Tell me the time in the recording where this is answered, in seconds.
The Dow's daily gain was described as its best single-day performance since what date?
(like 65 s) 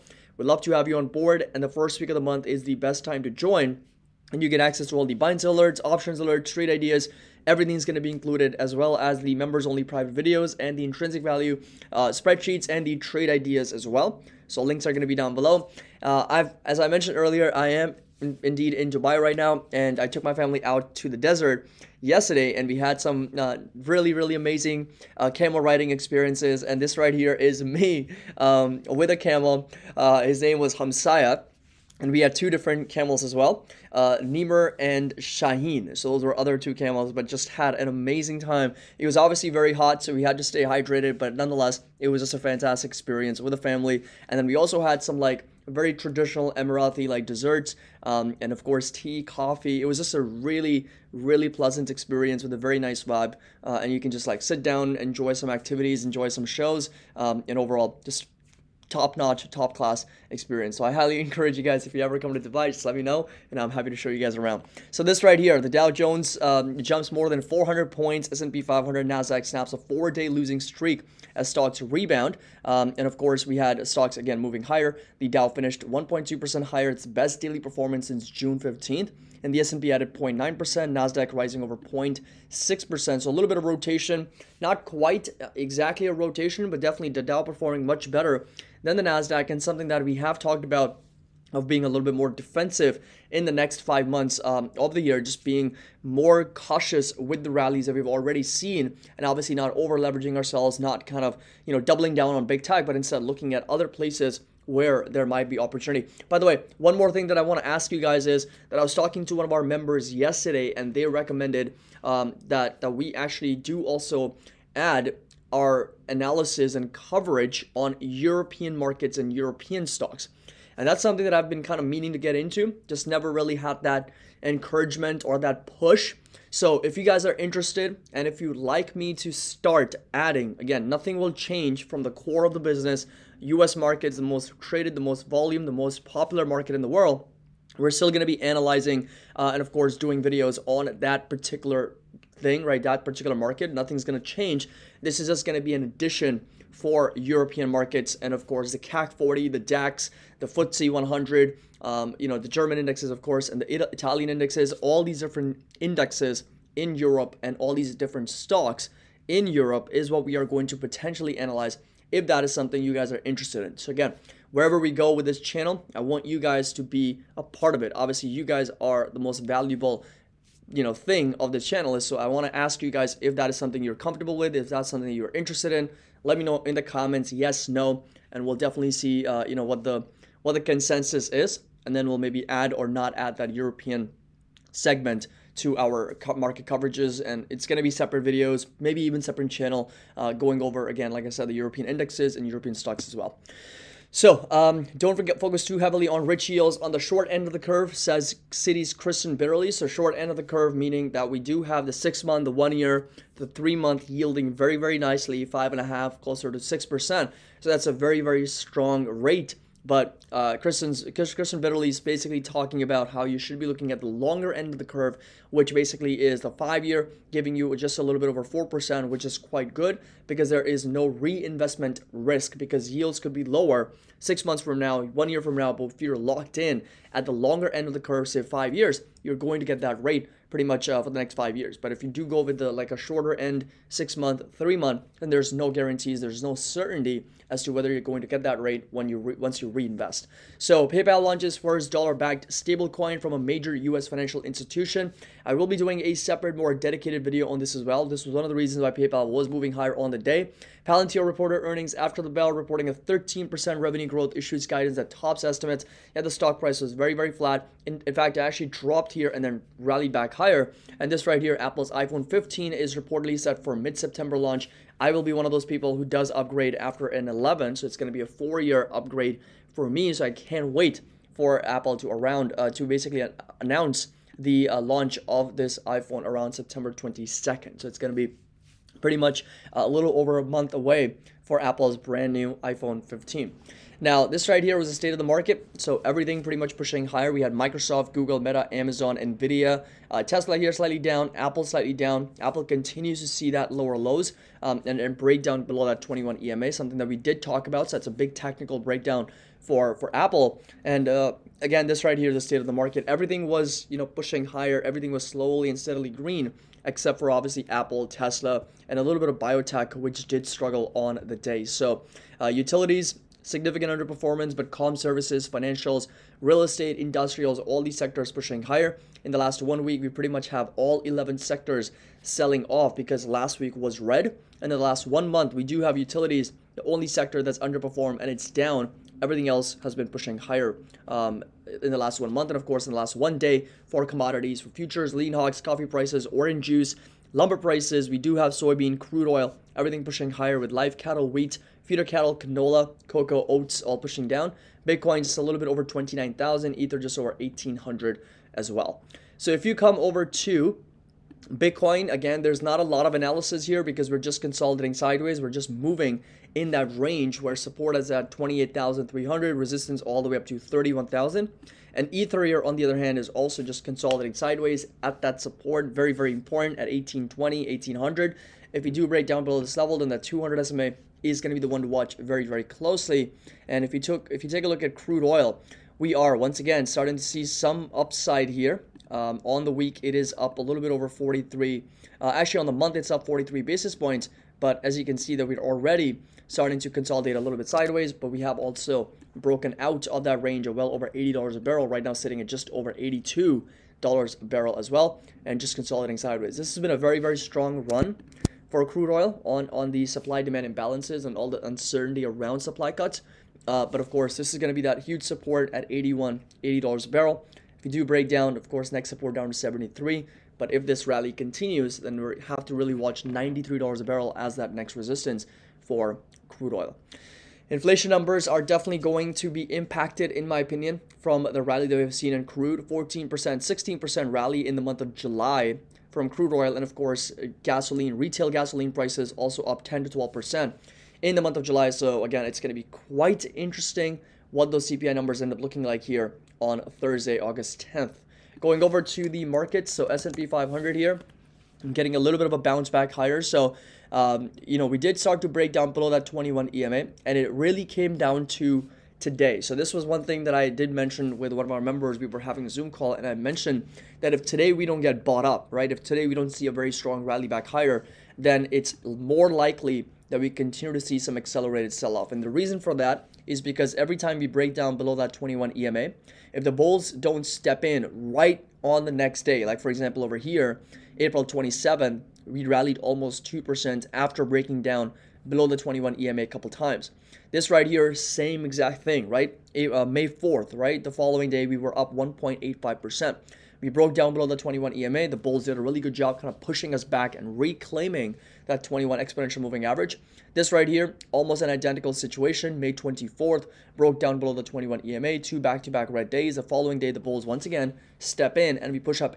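78 s.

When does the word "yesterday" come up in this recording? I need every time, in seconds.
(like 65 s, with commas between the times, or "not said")
22 s, 110 s.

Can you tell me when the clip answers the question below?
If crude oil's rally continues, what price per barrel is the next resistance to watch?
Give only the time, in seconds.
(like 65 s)
413 s.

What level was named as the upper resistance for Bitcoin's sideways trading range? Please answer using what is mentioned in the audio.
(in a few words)
31,000.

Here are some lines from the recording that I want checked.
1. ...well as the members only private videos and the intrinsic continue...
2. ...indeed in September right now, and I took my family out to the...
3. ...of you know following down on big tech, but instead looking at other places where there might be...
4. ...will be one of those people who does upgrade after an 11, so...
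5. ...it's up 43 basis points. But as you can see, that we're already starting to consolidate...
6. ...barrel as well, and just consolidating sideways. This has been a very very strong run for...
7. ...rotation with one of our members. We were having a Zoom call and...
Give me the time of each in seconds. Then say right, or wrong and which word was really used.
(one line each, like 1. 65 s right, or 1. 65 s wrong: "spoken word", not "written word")
1. 8 s wrong: "value", not "continue"
2. 18 s wrong: "Dubai", not "September"
3. 101 s wrong: "doubling", not "following"
4. 265 s right
5. 382 s right
6. 394 s right
7. 450 s wrong: "mention", not "rotation".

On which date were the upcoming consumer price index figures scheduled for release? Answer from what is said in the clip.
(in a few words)
Thursday August 10th.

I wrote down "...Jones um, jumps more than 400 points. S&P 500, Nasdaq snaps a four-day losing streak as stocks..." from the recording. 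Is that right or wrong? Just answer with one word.
right.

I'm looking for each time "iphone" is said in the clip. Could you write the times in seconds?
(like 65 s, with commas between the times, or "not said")
261 s, 275 s, 282 s.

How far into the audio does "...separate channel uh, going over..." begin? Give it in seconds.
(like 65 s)
189 s.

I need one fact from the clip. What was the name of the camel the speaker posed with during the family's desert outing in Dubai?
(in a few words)
Hamsaya.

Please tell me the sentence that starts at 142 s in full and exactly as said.
That particular market, nothing's going to change.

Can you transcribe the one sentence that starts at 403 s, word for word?
Uh, but of course, this is going to be that huge support at 81, 80 dollars a barrel.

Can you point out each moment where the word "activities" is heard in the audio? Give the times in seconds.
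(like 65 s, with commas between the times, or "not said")
55 s.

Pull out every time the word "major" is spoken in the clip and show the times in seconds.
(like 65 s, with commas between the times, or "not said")
243 s.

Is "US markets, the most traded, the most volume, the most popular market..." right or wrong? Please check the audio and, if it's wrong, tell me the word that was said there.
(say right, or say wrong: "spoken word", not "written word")
right.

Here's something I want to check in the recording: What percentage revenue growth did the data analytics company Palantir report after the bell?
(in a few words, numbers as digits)
13%.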